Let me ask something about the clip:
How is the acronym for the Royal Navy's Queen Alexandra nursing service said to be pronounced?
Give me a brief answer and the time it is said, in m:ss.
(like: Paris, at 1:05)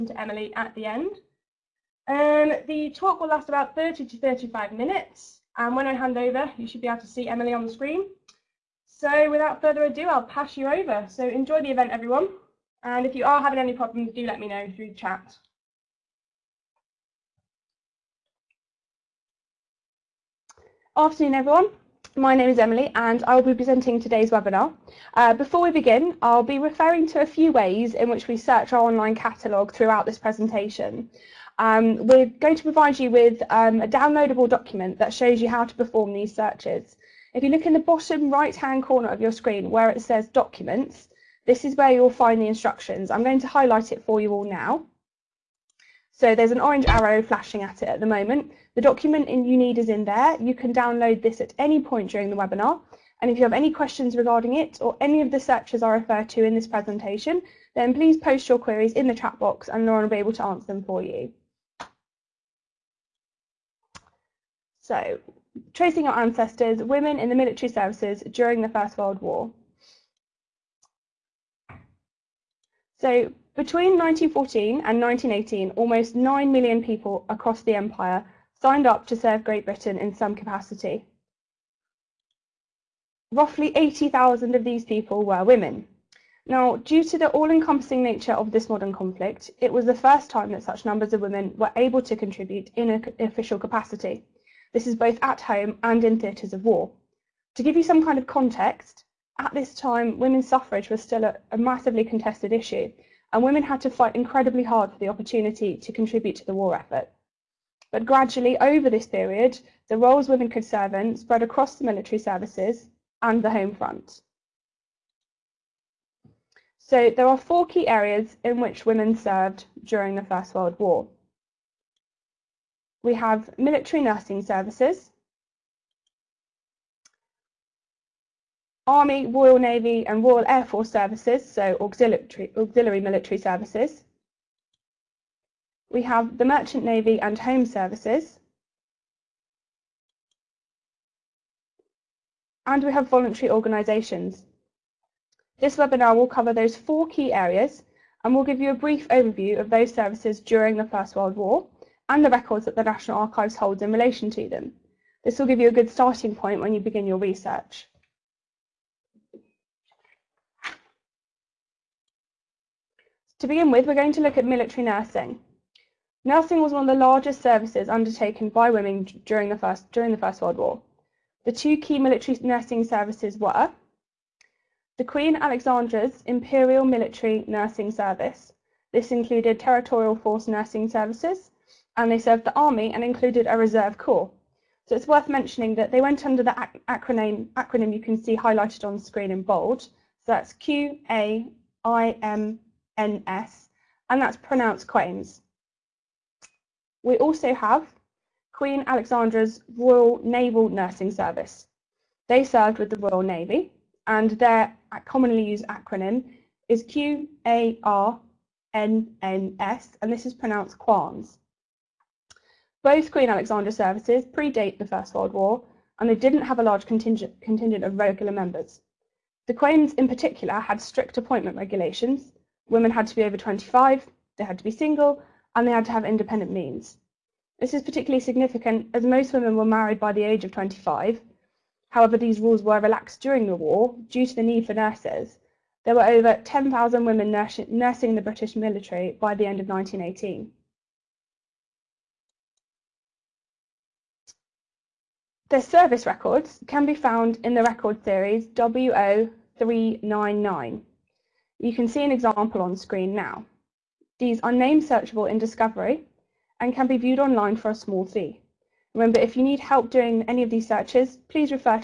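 Quans, at 3:30.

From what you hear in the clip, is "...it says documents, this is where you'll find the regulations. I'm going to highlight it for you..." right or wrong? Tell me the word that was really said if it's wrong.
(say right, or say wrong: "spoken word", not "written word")
wrong: "instructions", not "regulations".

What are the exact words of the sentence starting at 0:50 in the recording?
You can download this at any point during the webinar.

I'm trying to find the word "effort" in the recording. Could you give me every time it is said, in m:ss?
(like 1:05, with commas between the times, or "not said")
1:46.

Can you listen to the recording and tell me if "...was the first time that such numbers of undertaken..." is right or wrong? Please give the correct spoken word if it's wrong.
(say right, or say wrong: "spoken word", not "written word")
wrong: "women", not "undertaken".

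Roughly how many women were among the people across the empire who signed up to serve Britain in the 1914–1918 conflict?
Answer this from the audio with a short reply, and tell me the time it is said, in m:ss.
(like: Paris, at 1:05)
80,000, at 1:23.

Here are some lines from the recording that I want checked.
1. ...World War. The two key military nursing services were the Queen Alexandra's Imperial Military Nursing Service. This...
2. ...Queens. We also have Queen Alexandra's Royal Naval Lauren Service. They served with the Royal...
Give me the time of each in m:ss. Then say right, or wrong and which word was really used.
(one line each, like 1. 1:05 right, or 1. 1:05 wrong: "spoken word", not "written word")
1. 2:50 right
2. 3:14 wrong: "Nursing", not "Lauren".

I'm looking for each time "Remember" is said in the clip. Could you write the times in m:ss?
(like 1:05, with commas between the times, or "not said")
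4:18.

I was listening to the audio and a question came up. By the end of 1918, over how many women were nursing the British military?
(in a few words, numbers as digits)
10,000.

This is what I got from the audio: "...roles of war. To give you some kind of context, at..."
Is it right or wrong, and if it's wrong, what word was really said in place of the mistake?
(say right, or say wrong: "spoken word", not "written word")
wrong: "theatres", not "roles".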